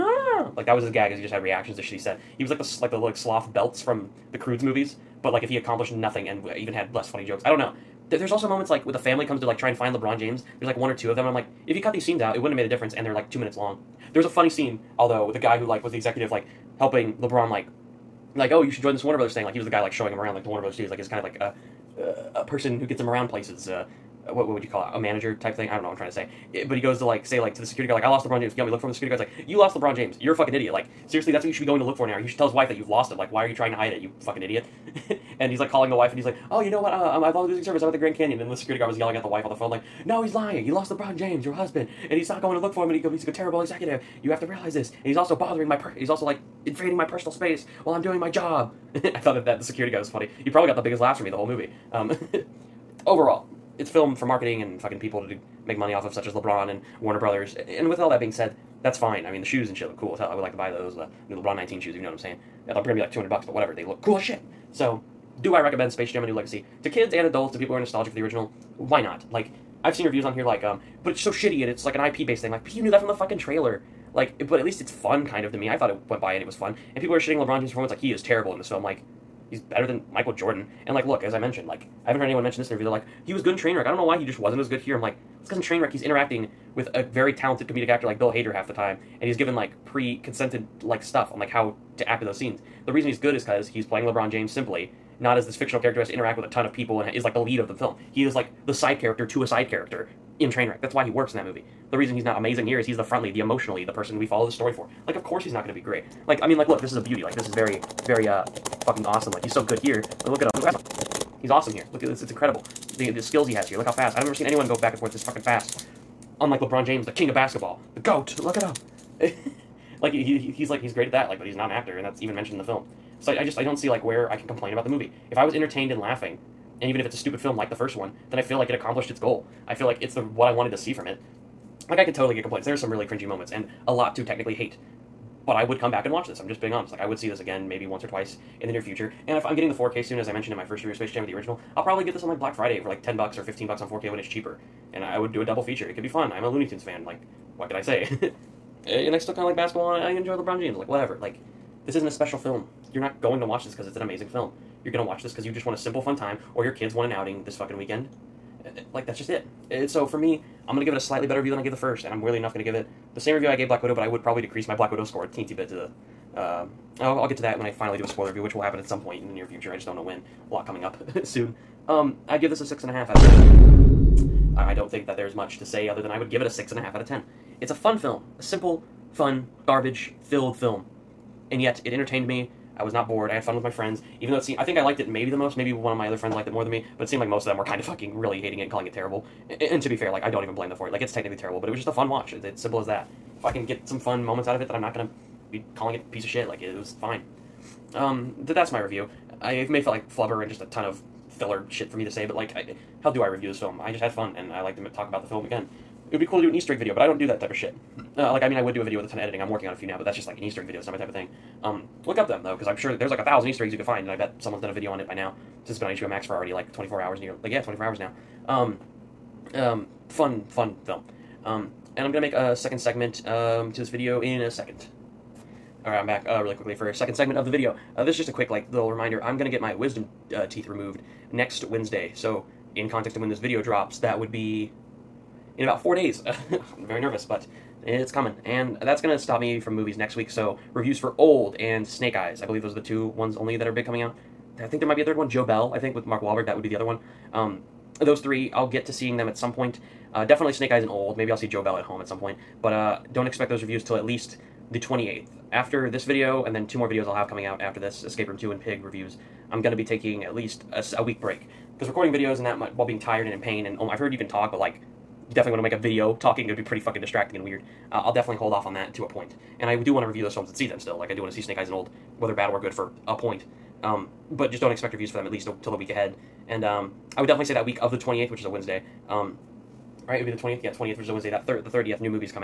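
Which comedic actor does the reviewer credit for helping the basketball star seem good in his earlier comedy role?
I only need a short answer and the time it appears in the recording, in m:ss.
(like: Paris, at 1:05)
Bill Hader, at 1:28.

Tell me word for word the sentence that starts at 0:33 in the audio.
Like, why are you trying to hide it, you fucking idiot?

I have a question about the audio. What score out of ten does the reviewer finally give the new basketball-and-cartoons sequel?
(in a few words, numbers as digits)
6.5.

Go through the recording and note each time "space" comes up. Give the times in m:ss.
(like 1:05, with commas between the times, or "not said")
0:47, 1:05, 2:20.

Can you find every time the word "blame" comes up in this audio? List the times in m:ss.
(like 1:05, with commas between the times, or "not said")
3:10.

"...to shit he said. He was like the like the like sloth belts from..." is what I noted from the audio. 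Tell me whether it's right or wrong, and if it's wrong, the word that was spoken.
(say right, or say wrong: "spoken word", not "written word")
right.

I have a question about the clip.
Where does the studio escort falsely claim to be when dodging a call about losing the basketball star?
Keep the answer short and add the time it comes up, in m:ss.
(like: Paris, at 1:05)
Grand Canyon, at 0:37.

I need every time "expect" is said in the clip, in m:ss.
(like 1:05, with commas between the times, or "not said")
4:13, 4:34.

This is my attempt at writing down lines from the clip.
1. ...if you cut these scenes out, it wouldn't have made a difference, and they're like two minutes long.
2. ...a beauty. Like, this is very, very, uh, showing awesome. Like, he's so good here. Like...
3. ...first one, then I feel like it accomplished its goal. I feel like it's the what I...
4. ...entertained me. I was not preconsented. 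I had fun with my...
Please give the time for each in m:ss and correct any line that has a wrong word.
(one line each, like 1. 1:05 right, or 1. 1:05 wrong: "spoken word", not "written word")
1. 0:11 right
2. 1:46 wrong: "fucking", not "showing"
3. 2:07 right
4. 3:01 wrong: "bored", not "preconsented".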